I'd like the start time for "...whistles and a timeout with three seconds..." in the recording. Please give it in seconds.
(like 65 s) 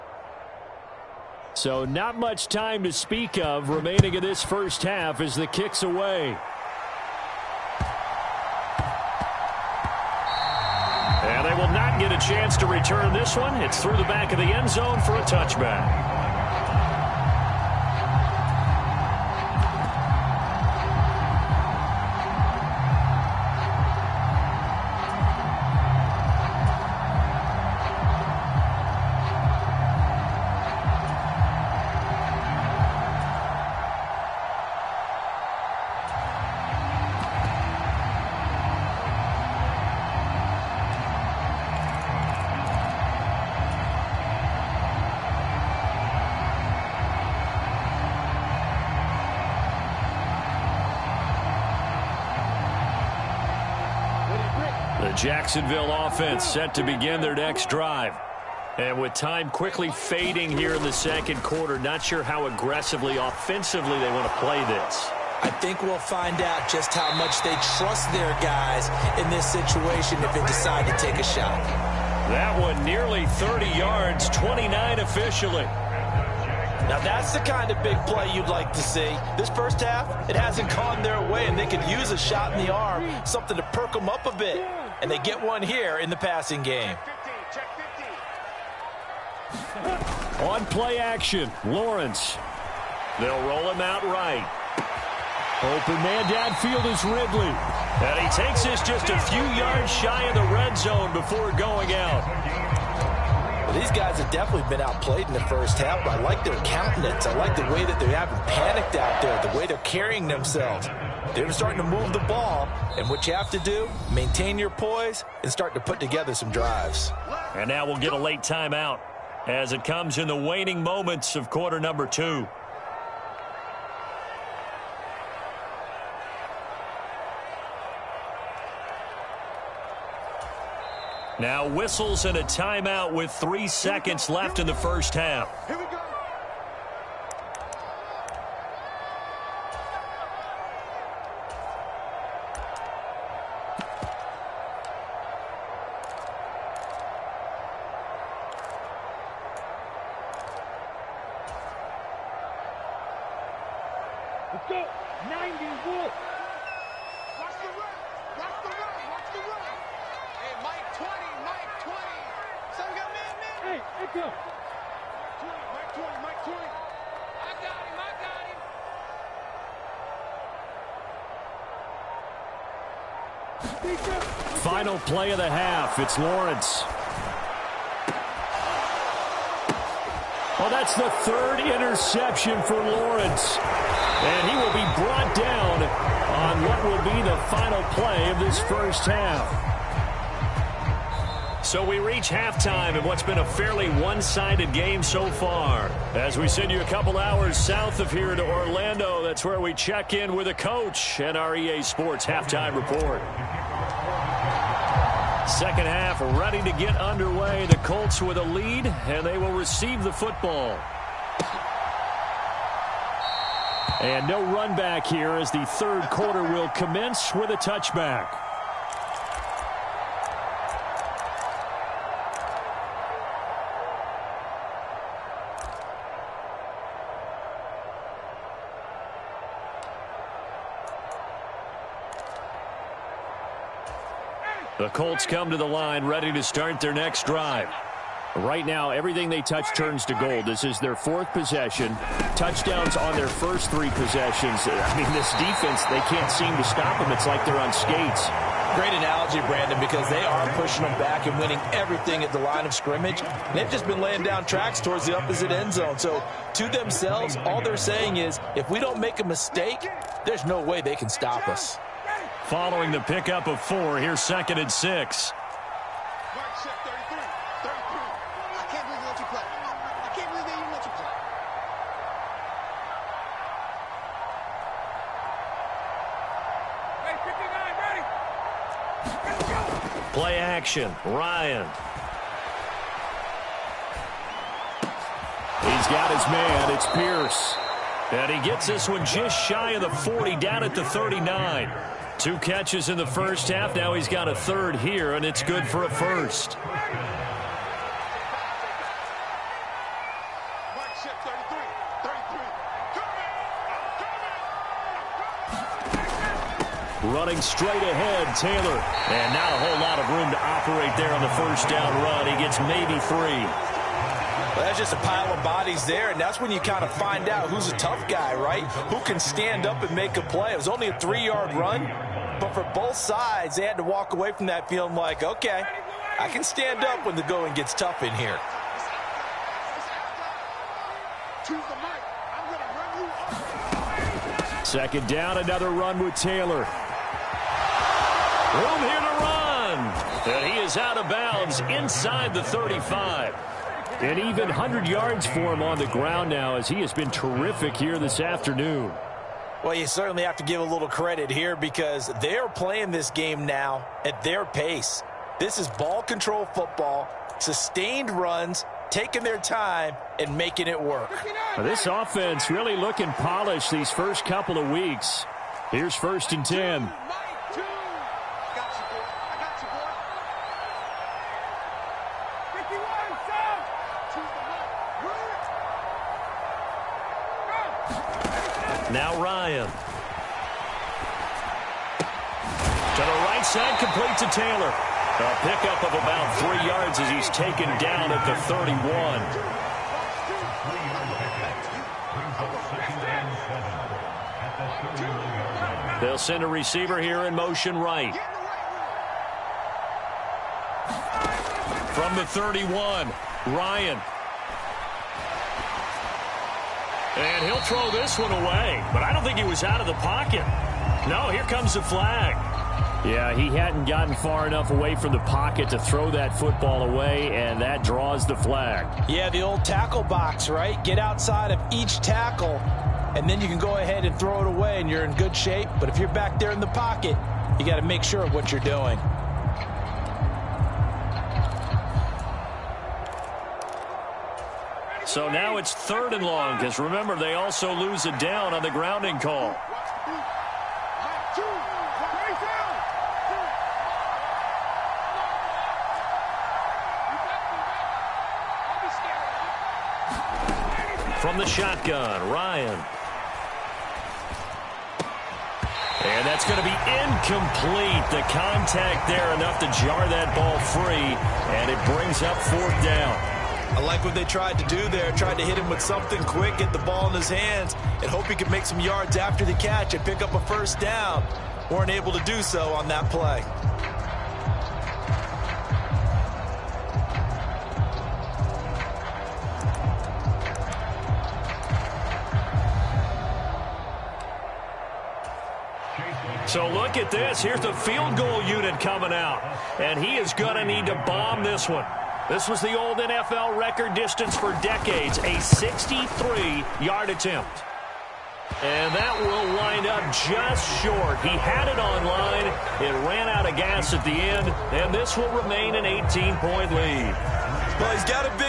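131 s.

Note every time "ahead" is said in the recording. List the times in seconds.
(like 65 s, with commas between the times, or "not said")
307 s, 423 s.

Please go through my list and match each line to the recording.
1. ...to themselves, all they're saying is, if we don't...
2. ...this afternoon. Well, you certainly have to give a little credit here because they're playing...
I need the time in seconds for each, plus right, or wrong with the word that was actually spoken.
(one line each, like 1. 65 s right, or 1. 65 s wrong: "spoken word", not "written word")
1. 256 s right
2. 347 s right.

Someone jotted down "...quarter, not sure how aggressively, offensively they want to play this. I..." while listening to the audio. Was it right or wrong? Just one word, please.
right.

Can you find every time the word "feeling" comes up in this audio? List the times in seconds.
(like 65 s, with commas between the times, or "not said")
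324 s.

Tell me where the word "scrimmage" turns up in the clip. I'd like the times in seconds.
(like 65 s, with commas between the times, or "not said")
252 s.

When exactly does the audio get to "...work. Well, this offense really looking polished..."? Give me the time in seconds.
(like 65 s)
360 s.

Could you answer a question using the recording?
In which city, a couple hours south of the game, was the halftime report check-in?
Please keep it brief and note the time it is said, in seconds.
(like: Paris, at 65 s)
Orlando, at 198 s.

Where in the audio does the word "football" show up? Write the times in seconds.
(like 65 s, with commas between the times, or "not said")
210 s, 356 s, 416 s.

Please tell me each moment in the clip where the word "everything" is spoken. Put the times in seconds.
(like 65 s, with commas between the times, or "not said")
238 s, 251 s.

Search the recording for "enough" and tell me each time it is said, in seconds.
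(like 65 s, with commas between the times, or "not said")
414 s, 459 s.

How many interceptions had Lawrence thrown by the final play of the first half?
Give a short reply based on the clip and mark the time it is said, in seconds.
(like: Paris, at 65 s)
3, at 181 s.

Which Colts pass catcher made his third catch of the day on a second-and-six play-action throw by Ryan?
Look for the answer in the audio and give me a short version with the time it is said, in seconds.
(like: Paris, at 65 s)
Pierce, at 286 s.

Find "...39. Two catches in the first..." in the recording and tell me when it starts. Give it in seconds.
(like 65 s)
290 s.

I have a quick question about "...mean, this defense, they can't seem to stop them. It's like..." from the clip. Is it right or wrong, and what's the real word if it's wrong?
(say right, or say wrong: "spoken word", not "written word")
right.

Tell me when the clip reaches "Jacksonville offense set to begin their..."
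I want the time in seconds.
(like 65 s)
55 s.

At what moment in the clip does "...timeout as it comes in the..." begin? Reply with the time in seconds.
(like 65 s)
118 s.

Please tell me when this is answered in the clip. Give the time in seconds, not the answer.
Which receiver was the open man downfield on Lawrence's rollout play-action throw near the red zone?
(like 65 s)
97 s.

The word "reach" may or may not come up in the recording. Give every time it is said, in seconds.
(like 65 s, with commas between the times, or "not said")
191 s.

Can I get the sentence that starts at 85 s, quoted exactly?
And they get one here in the passing game.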